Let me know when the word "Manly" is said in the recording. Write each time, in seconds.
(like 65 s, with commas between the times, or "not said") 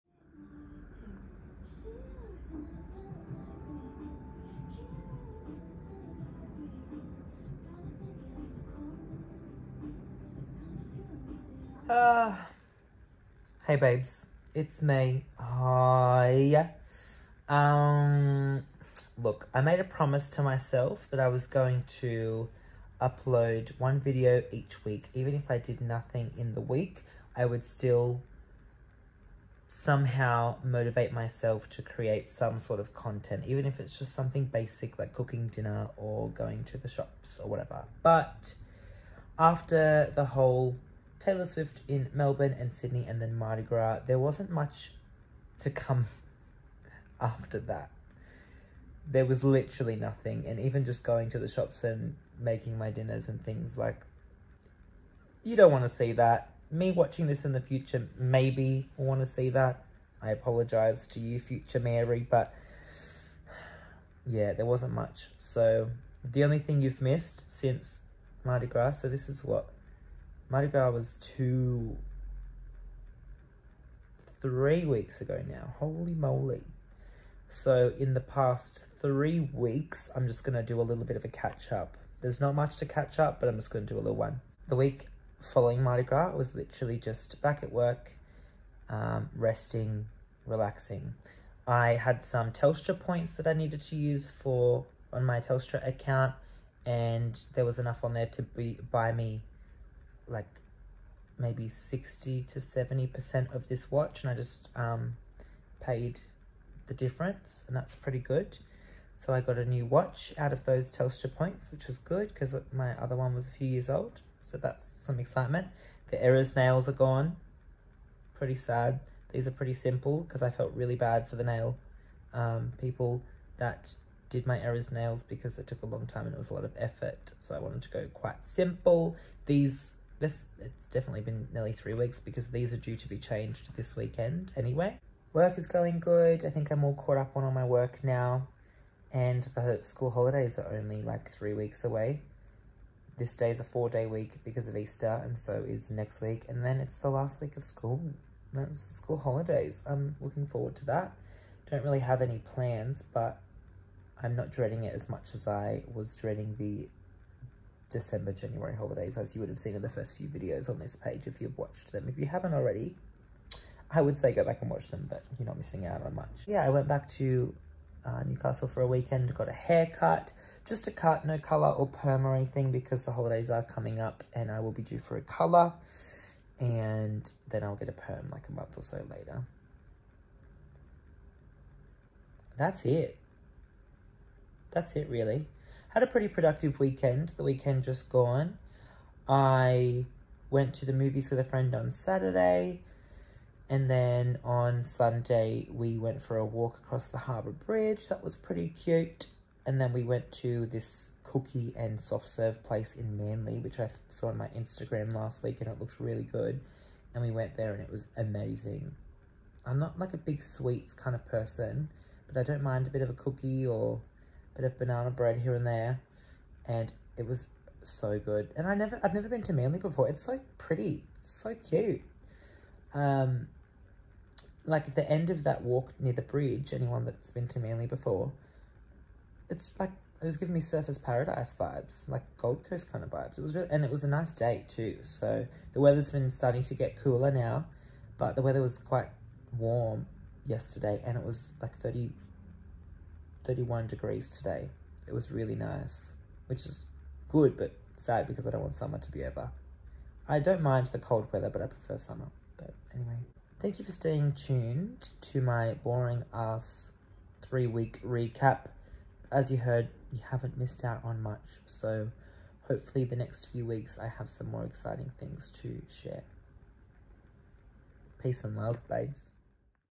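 203 s, 219 s, 227 s.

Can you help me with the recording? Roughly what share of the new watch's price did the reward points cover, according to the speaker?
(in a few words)
60 to 70%.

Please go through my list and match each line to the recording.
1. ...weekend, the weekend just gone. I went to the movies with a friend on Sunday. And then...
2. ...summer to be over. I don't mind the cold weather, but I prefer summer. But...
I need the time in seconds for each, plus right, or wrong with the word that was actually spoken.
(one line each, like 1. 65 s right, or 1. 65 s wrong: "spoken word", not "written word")
1. 186 s wrong: "Saturday", not "Sunday"
2. 248 s right.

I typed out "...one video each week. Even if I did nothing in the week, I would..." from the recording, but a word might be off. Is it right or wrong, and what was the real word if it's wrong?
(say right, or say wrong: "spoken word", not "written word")
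right.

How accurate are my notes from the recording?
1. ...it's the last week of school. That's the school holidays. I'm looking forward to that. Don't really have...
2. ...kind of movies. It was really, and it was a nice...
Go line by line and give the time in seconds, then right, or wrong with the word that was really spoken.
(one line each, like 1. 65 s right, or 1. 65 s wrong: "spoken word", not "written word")
1. 146 s right
2. 232 s wrong: "vibes", not "movies".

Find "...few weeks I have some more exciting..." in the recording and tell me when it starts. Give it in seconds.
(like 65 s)
263 s.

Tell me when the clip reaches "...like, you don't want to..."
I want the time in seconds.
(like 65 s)
53 s.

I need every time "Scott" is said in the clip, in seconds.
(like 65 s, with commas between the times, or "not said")
not said.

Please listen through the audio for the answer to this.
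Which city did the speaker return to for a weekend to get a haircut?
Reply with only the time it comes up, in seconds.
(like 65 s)
168 s.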